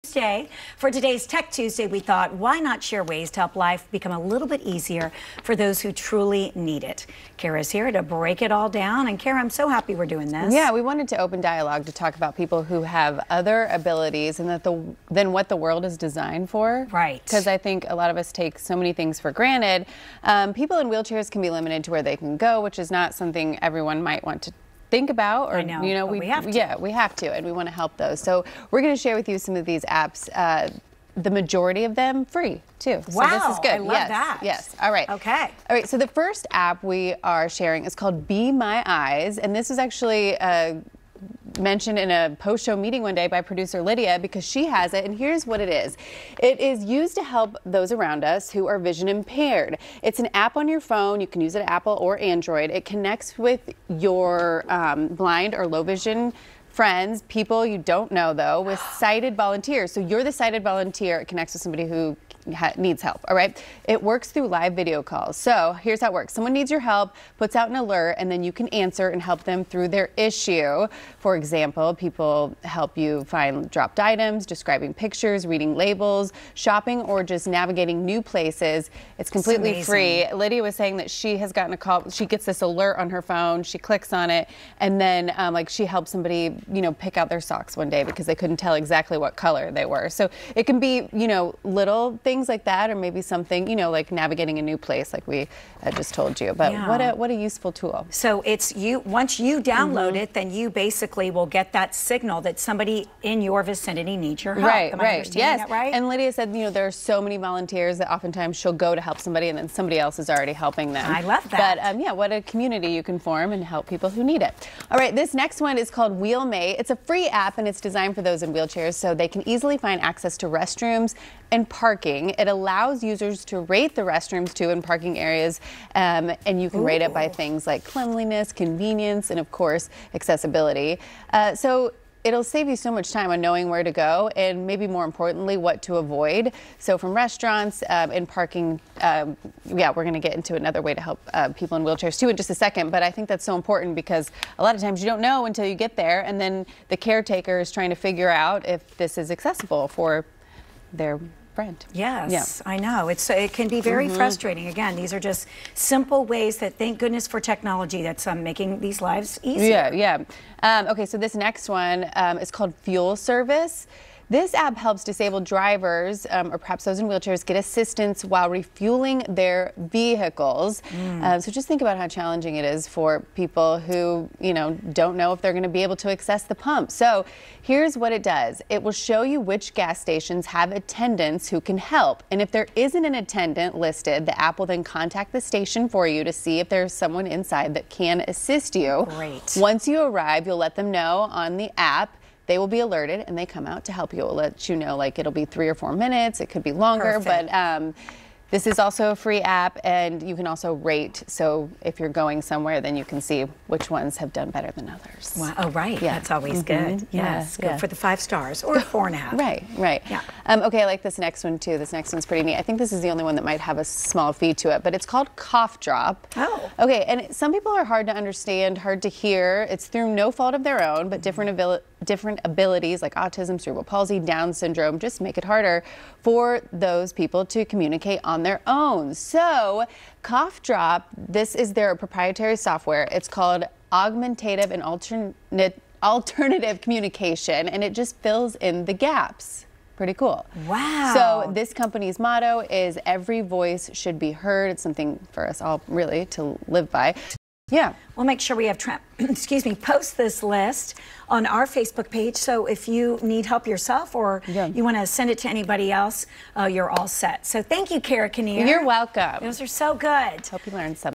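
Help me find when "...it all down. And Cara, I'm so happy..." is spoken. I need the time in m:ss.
0:08.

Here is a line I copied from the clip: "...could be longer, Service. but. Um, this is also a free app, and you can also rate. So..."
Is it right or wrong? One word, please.
wrong.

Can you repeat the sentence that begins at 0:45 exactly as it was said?
And here's what it is it is used to help those around us who are vision impaired.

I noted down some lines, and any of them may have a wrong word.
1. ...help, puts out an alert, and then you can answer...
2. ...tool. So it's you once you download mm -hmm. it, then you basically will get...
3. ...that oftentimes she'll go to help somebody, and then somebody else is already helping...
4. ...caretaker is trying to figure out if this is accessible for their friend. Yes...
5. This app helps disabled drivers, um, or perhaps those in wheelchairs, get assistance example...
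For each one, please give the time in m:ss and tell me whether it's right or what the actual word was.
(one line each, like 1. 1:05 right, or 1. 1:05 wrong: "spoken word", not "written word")
1. 1:06 right
2. 1:37 right
3. 1:47 right
4. 2:26 right
5. 2:44 wrong: "while", not "example".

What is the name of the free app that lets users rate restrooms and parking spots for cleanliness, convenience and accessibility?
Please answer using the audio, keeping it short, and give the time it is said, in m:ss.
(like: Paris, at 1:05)
WheelMate, at 1:56.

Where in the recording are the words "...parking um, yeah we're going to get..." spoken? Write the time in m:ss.
2:18.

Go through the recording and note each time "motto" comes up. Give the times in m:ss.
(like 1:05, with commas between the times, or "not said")
4:02.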